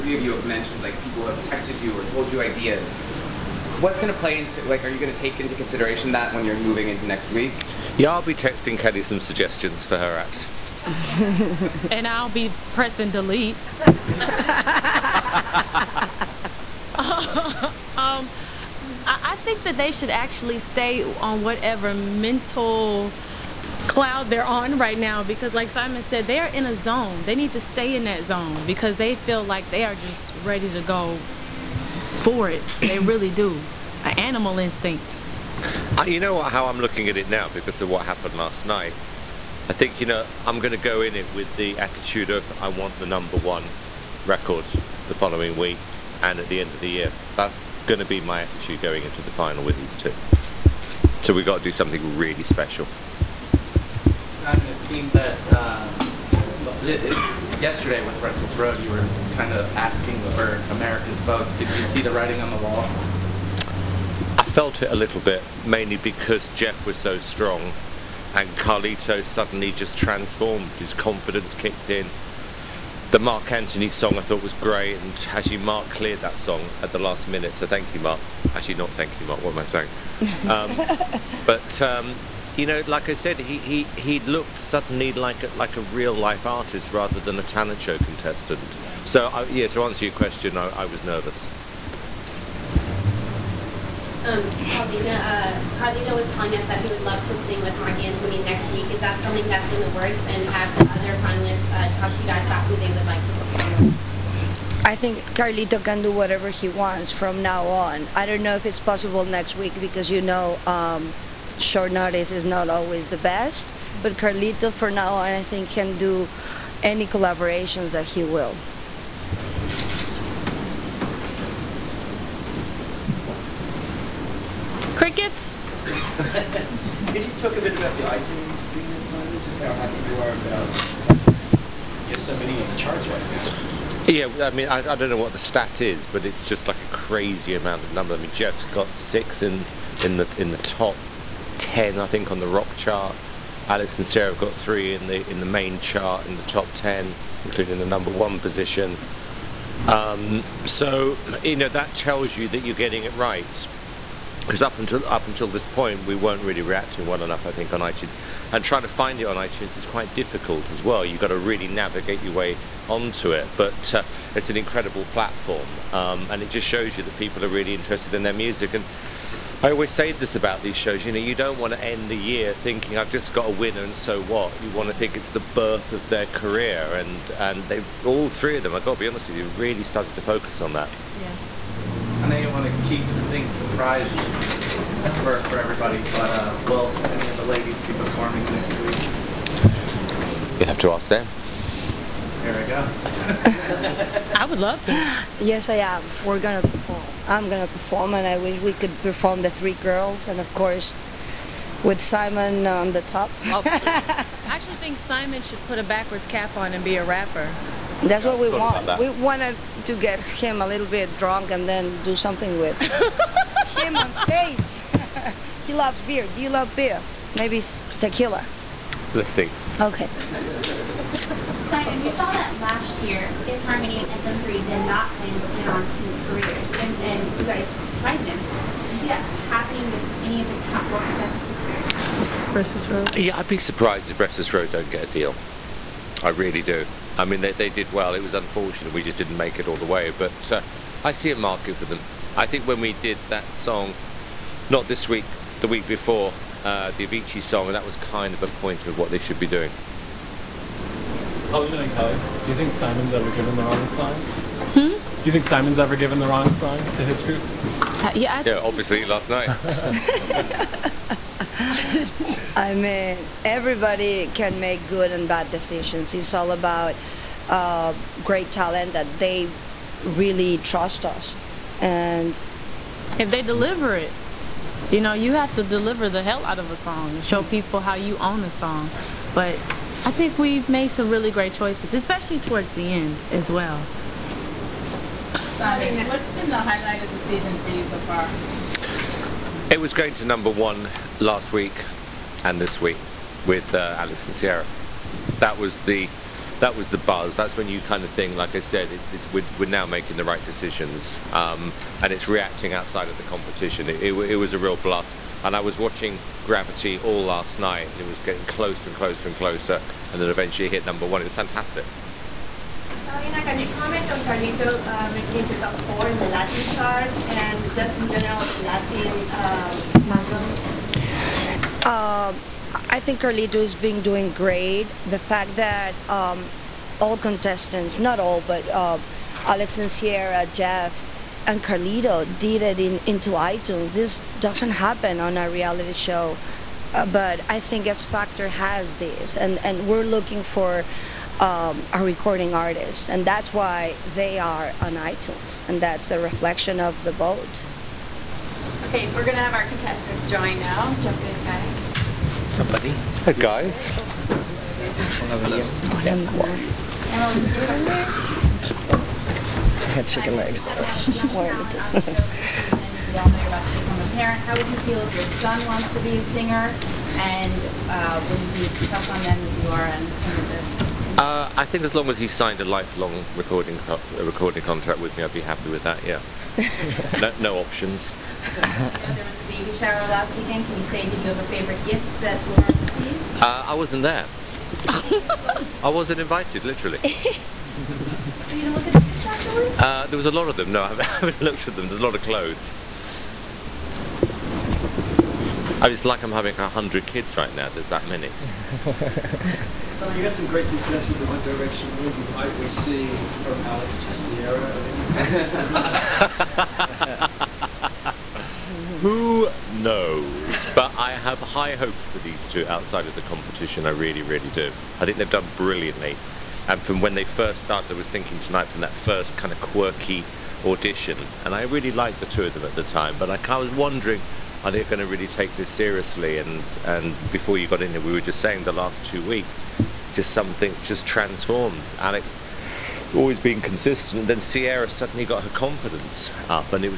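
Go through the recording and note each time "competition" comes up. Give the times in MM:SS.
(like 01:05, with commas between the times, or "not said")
05:03, 06:53.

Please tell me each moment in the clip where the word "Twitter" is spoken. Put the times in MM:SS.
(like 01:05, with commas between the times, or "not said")
not said.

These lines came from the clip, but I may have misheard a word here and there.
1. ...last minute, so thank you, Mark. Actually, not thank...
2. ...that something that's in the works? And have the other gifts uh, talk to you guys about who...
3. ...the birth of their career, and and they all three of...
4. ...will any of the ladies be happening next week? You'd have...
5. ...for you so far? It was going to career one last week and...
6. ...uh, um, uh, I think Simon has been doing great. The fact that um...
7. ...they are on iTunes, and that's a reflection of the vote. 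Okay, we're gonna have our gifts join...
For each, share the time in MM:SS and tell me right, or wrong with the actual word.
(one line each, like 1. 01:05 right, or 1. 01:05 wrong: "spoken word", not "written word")
1. 01:16 right
2. 01:38 wrong: "finalists", not "gifts"
3. 02:55 right
4. 03:06 wrong: "performing", not "happening"
5. 04:47 wrong: "number", not "career"
6. 05:20 wrong: "Carlito", not "Simon"
7. 05:44 wrong: "contestants", not "gifts".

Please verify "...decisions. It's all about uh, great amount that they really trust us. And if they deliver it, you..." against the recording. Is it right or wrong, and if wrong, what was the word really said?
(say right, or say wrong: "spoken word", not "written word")
wrong: "talent", not "amount".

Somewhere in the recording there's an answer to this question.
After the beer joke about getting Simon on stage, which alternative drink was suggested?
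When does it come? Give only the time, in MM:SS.
03:37.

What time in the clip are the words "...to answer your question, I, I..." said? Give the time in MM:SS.
01:29.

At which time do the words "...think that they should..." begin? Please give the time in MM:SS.
00:19.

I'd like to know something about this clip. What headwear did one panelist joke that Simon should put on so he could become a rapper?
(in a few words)
A backwards cap.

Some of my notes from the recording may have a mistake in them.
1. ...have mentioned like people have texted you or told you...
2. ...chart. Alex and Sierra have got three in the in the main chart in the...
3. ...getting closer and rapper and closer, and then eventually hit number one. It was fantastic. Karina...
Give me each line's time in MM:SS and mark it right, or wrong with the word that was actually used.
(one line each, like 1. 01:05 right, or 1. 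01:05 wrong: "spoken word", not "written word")
1. 00:00 right
2. 02:22 right
3. 05:08 wrong: "closer", not "rapper".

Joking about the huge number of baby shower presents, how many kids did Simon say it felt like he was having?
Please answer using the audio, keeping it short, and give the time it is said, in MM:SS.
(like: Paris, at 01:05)
100, at 06:36.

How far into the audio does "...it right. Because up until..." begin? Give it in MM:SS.
02:33.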